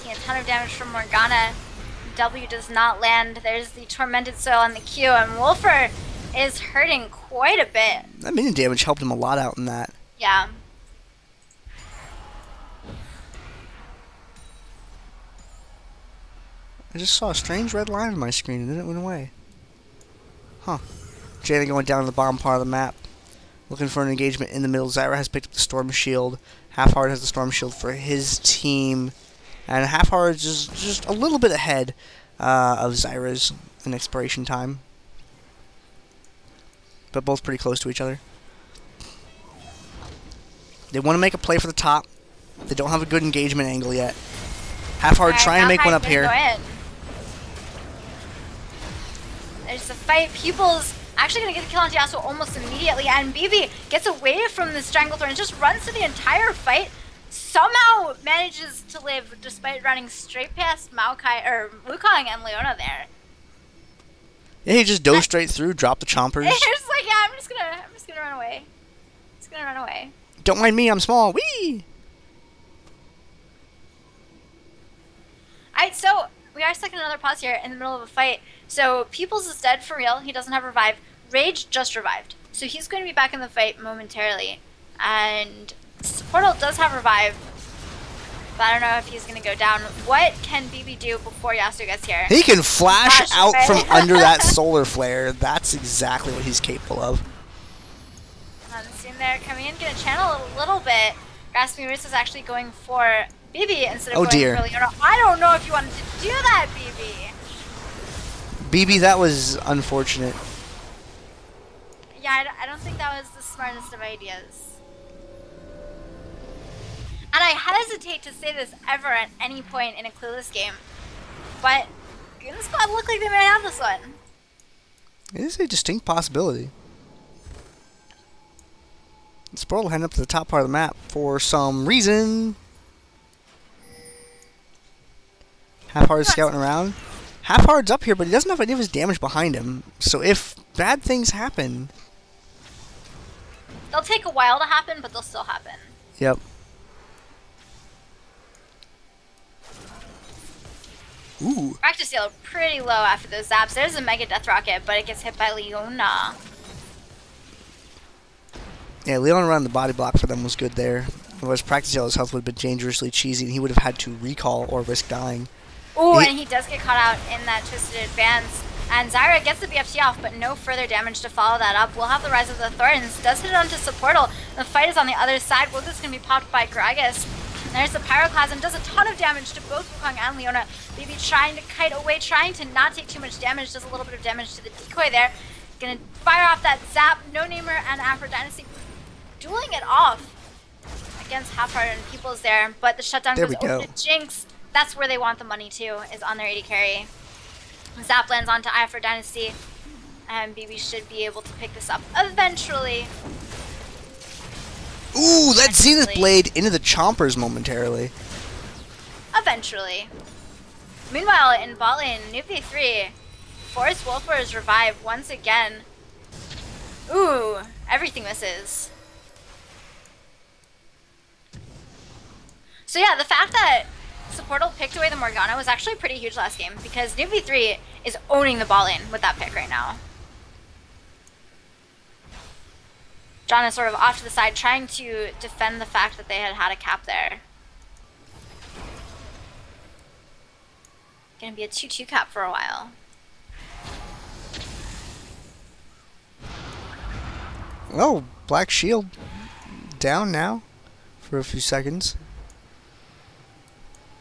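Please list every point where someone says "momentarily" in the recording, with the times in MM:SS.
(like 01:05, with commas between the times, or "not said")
01:23, 03:27.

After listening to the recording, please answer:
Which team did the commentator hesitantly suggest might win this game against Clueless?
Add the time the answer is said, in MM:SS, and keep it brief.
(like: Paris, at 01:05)
Goon Squad, at 02:02.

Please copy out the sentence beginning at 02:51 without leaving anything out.
We'll have the Rise of the Thorns.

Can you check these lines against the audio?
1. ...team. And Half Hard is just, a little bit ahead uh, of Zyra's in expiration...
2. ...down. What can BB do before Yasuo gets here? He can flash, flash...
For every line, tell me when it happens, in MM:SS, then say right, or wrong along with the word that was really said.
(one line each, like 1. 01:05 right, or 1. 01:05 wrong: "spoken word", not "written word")
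1. 00:28 right
2. 01:29 right.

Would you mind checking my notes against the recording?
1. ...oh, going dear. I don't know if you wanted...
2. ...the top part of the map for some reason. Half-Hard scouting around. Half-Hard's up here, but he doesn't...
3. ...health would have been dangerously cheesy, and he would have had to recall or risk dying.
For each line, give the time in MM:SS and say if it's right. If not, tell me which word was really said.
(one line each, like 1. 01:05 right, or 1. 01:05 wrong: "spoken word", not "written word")
1. 01:44 right
2. 02:10 right
3. 02:42 right.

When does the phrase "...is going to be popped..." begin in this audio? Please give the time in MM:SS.
02:55.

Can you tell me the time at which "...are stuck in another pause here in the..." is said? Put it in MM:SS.
01:16.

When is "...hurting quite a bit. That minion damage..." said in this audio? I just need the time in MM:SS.
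00:06.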